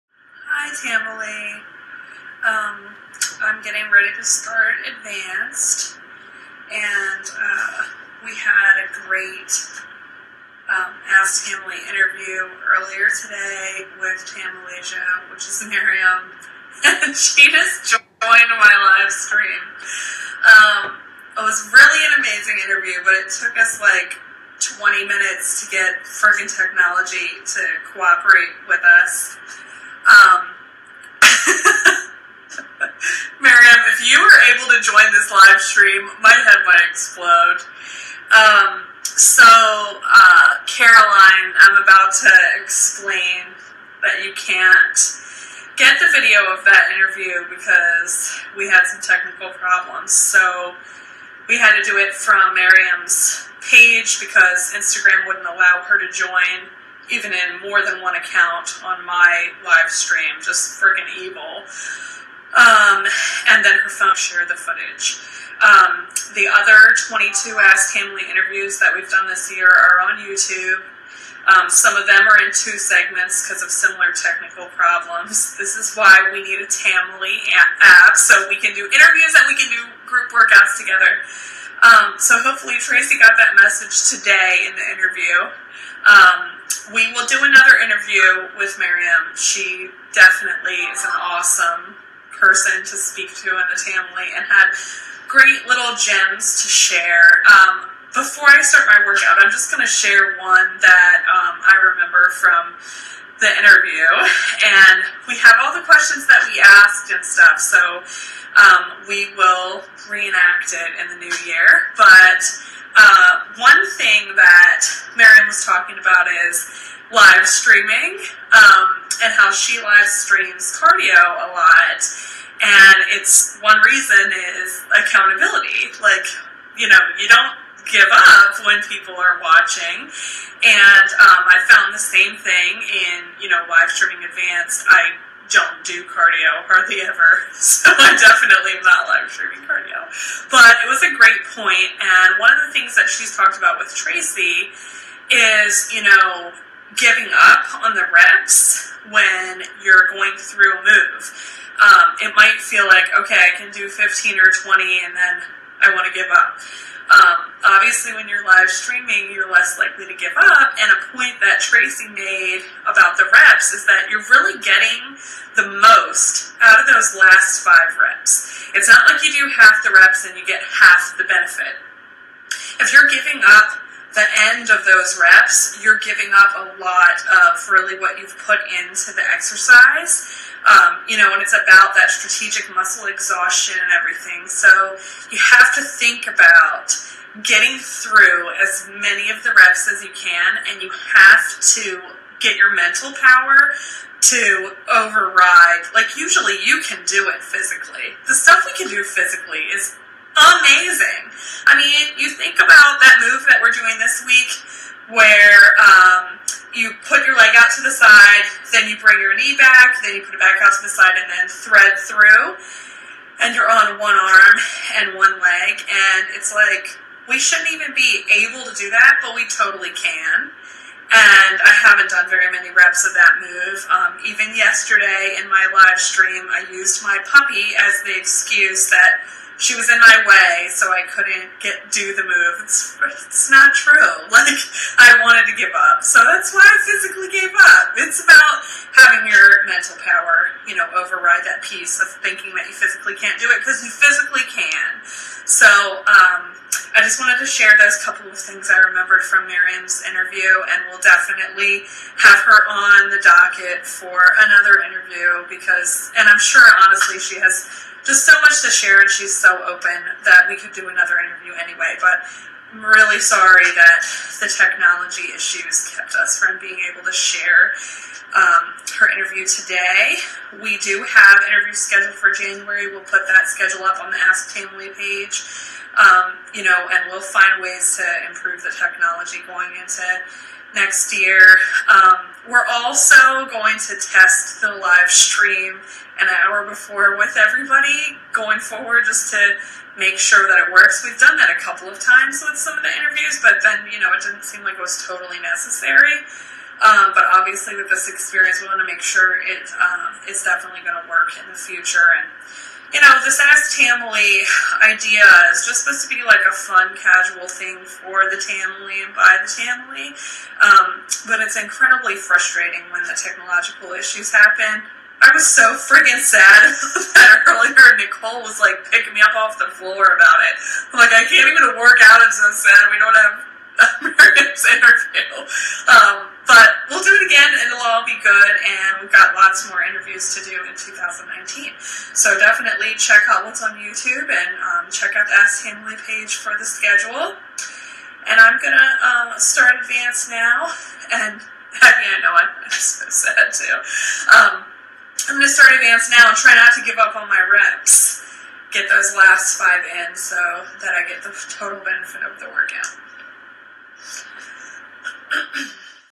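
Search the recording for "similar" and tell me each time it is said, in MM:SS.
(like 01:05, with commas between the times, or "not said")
01:13.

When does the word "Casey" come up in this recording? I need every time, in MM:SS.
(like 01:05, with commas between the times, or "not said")
not said.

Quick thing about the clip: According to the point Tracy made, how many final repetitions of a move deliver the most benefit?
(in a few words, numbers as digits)
5.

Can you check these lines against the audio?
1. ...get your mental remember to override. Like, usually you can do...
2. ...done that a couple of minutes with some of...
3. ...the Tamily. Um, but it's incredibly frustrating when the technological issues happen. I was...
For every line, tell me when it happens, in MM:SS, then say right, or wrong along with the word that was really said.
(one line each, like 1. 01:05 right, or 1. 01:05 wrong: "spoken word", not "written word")
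1. 03:12 wrong: "power", not "remember"
2. 04:51 wrong: "times", not "minutes"
3. 05:09 right.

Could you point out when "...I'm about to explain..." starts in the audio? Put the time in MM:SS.
00:41.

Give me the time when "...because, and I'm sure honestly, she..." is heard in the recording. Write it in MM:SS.
04:15.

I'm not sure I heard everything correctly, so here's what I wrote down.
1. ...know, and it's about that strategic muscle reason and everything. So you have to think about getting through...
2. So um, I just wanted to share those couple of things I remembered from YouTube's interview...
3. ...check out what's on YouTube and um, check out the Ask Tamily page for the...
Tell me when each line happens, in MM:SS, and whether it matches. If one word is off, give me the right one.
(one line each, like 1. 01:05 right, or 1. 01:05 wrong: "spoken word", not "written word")
1. 03:01 wrong: "exhaustion", not "reason"
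2. 04:05 wrong: "Miriam", not "YouTube"
3. 05:32 right.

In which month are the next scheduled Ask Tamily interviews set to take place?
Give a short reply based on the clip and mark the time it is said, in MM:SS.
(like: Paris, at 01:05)
January, at 04:32.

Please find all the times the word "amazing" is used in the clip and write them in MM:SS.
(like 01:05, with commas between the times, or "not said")
00:22, 03:20.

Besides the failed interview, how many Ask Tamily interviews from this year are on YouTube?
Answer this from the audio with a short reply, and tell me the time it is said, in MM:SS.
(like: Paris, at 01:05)
22, at 01:07.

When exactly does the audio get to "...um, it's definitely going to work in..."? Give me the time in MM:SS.
04:59.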